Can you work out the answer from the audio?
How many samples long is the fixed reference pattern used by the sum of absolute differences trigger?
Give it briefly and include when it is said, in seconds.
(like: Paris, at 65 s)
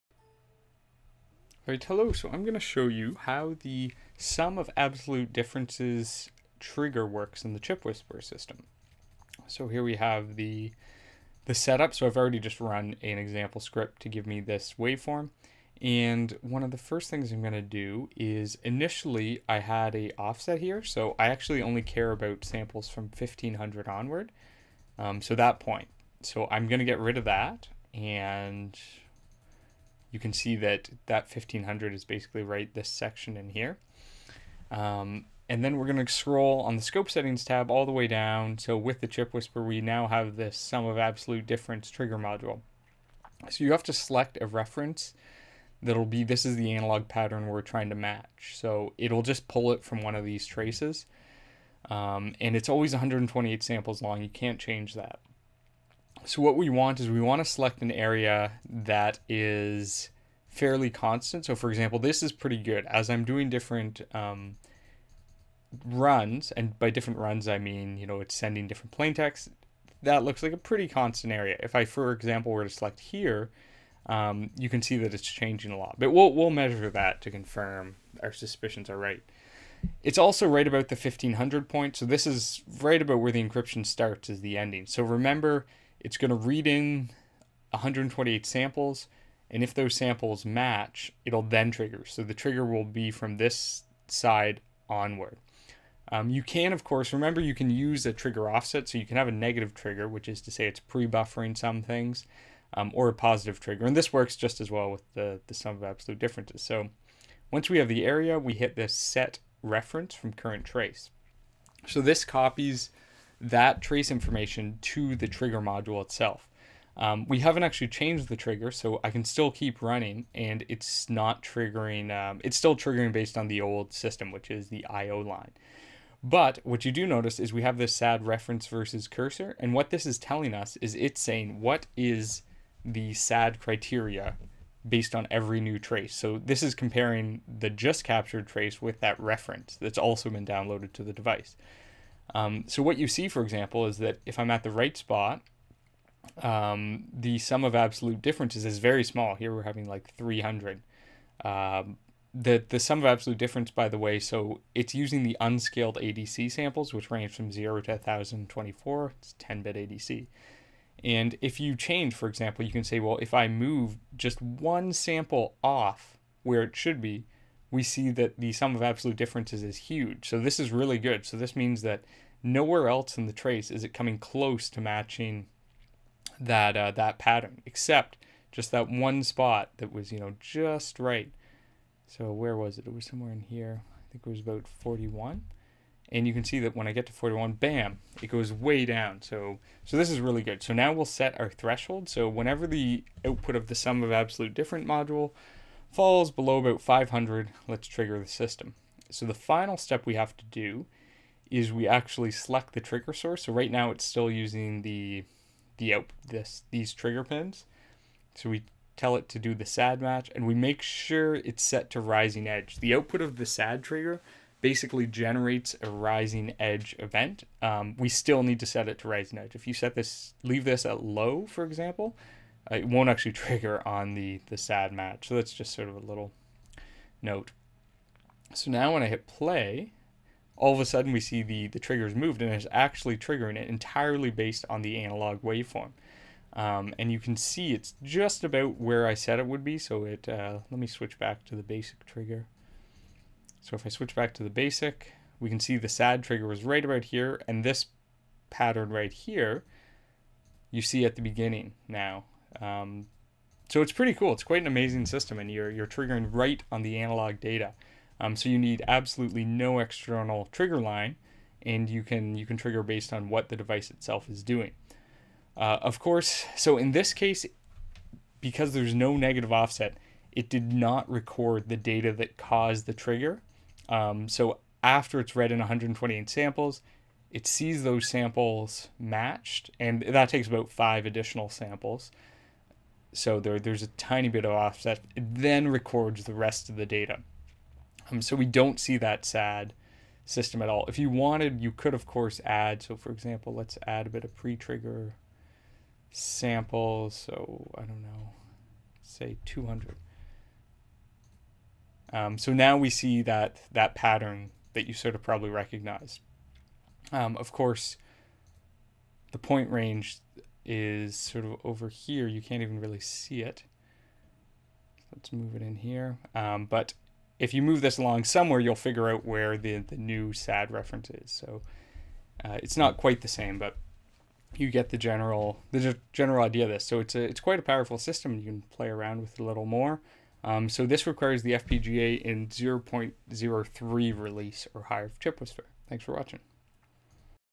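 128, at 52 s.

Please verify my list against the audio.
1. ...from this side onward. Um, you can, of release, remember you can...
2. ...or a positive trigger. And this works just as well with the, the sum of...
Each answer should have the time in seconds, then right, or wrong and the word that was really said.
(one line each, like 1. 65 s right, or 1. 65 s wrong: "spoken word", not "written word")
1. 93 s wrong: "course", not "release"
2. 102 s right.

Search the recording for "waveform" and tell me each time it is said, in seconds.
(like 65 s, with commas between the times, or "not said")
14 s, 235 s.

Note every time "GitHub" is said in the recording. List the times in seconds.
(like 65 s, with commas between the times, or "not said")
not said.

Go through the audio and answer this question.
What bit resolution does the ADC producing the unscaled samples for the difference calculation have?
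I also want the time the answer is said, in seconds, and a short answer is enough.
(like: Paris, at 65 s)
10-bit, at 159 s.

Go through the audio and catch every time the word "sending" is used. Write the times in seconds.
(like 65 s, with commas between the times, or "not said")
68 s.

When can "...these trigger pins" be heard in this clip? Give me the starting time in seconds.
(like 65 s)
206 s.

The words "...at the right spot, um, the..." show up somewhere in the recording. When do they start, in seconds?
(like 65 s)
144 s.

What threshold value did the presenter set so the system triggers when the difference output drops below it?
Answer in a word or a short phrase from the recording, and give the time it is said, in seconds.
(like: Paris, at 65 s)
500, at 196 s.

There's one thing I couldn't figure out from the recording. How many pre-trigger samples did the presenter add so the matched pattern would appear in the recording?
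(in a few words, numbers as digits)
200.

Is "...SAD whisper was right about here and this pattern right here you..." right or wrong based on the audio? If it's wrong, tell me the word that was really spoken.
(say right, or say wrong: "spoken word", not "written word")
wrong: "trigger", not "whisper".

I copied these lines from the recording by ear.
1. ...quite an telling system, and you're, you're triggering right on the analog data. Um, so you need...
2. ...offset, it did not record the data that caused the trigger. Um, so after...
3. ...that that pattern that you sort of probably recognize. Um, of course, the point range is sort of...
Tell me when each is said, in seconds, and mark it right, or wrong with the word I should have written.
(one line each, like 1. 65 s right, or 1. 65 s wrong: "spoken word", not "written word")
1. 254 s wrong: "amazing", not "telling"
2. 269 s right
3. 303 s right.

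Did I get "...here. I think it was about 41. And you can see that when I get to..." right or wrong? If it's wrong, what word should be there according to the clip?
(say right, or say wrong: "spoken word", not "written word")
right.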